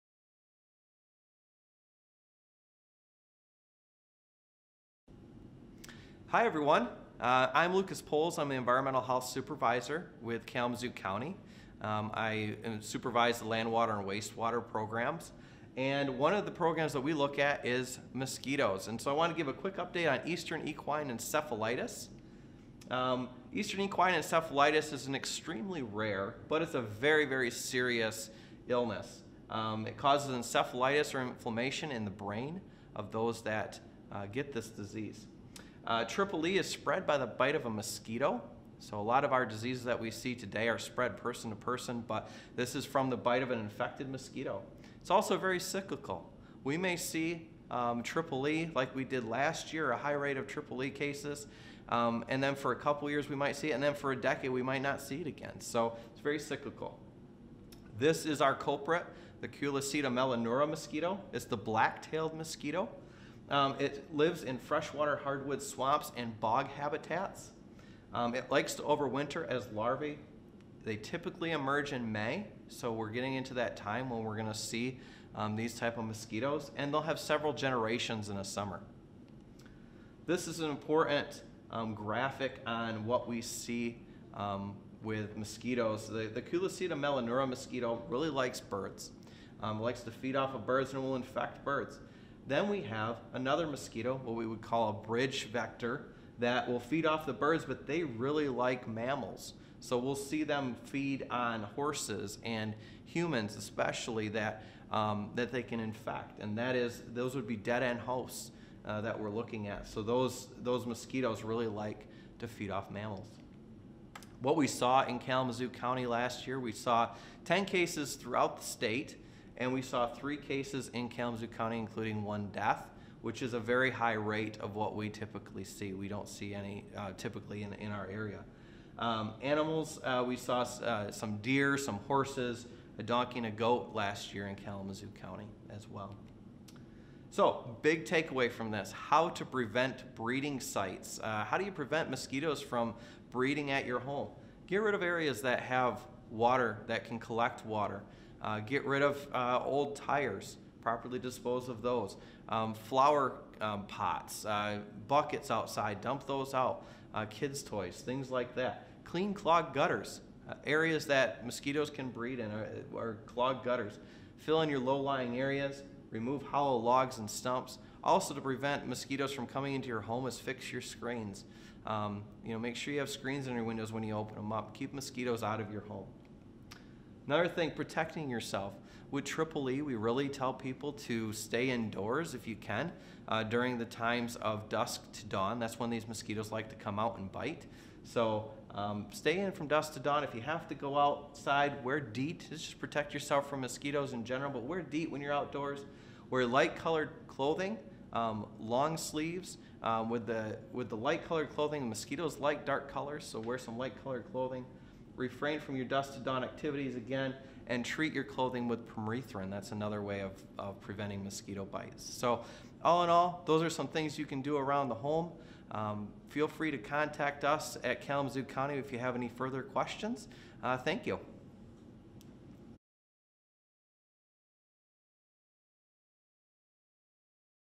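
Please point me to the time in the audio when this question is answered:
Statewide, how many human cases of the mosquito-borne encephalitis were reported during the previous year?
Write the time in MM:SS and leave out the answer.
01:57.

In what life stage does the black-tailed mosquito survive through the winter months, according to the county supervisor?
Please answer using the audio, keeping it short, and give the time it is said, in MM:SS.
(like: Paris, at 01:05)
Larvae, at 01:09.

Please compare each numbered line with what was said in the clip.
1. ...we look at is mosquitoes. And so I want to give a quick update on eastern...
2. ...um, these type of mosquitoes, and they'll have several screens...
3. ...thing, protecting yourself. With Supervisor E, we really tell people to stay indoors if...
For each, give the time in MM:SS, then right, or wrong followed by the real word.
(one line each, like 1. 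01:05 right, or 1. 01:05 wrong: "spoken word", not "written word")
1. 00:17 right
2. 01:15 wrong: "generations", not "screens"
3. 02:57 wrong: "Triple", not "Supervisor".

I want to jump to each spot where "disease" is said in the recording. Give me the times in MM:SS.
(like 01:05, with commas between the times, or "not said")
00:34, 00:39.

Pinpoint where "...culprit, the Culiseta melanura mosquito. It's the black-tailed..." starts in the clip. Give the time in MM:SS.
00:58.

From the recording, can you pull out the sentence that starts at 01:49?
So those those mosquitoes really like to feed off mammals.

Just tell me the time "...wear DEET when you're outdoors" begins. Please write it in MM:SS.
03:14.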